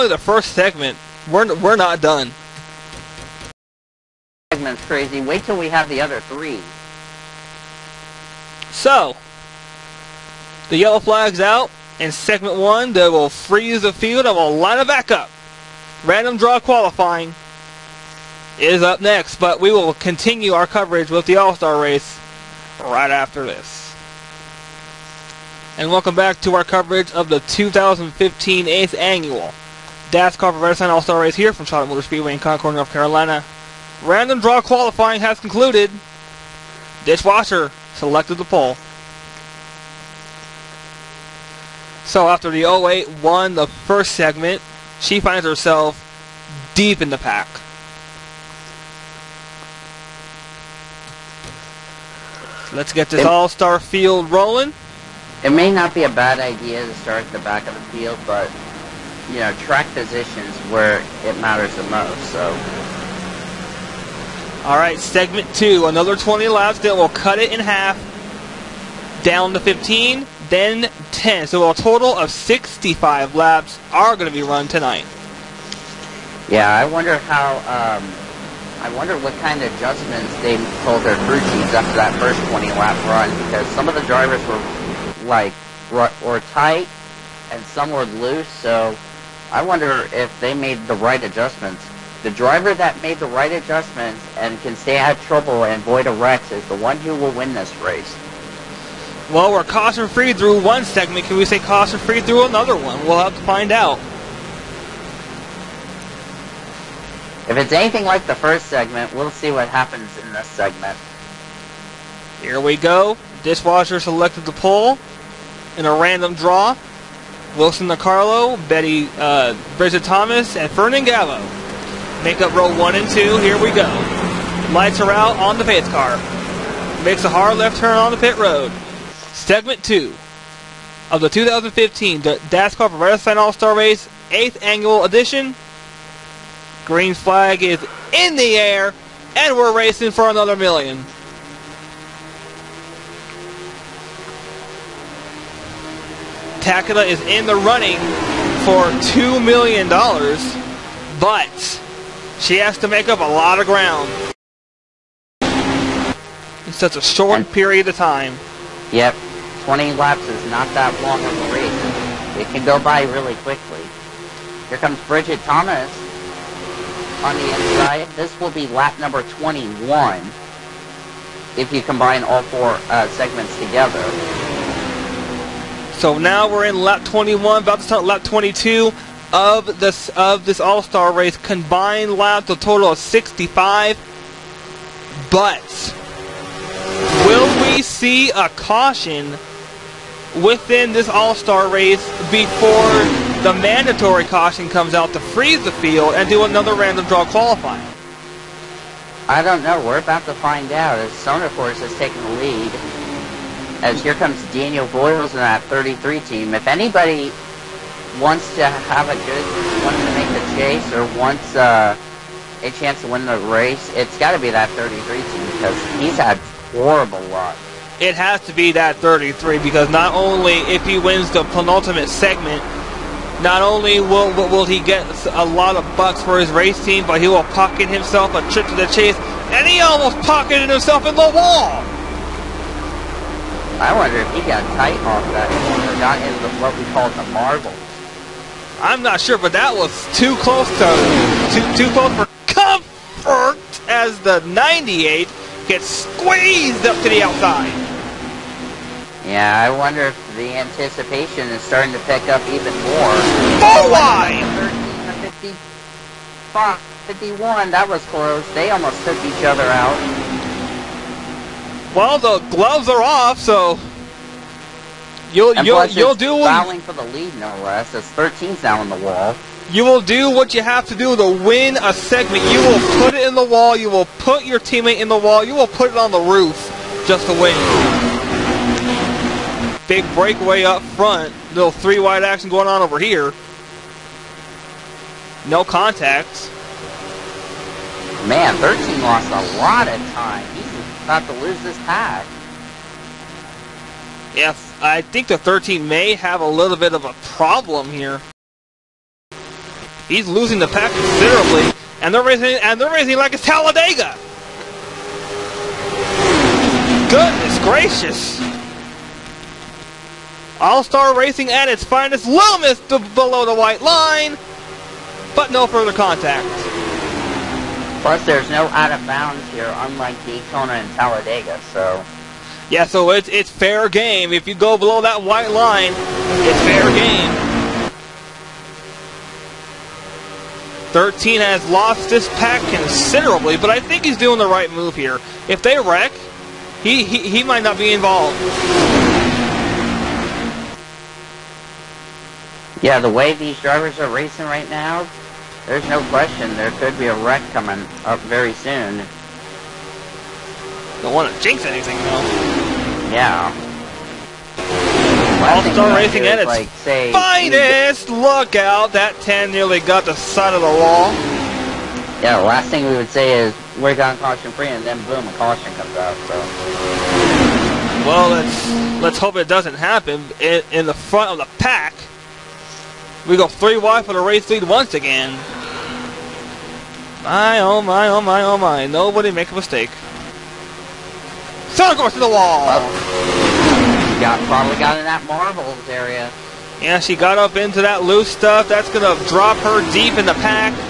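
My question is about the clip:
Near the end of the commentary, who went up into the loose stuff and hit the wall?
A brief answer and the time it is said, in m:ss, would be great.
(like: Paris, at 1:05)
Sonic, at 6:21.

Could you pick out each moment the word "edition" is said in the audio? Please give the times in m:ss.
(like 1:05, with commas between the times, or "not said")
2:15.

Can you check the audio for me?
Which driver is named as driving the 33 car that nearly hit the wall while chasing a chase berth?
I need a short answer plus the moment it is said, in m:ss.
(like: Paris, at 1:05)
Daniel Boyles, at 3:24.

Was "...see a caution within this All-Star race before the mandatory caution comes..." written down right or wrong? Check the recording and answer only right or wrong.
right.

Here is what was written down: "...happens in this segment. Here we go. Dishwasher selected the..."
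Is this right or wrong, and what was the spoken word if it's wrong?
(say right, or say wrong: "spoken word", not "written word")
right.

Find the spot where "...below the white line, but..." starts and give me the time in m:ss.
5:13.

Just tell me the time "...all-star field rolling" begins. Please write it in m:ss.
0:53.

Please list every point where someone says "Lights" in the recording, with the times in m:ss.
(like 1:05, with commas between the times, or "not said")
2:04.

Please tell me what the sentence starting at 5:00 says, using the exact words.
He's losing the pack considerably, and they're raising, and they're raising like it's Talladega.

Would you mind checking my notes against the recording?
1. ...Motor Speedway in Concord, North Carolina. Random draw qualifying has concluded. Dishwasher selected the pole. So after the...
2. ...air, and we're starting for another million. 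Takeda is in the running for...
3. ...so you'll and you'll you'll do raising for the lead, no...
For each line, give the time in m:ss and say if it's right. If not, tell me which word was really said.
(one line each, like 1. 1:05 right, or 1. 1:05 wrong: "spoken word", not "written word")
1. 0:31 right
2. 2:18 wrong: "racing", not "starting"
3. 4:23 wrong: "fouling", not "raising".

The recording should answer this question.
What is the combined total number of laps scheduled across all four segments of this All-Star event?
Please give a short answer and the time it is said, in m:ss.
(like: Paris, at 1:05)
65, at 1:11.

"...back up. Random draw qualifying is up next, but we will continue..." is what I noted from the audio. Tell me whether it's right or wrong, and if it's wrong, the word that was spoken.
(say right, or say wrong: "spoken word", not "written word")
right.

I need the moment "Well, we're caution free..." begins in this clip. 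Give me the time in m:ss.
1:39.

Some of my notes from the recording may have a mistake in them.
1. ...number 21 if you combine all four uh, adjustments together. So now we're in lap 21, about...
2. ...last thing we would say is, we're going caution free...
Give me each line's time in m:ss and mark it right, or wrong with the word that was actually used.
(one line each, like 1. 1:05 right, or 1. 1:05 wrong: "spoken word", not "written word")
1. 2:48 wrong: "segments", not "adjustments"
2. 6:02 right.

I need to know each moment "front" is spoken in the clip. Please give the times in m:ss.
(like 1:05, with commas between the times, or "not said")
4:40, 6:10.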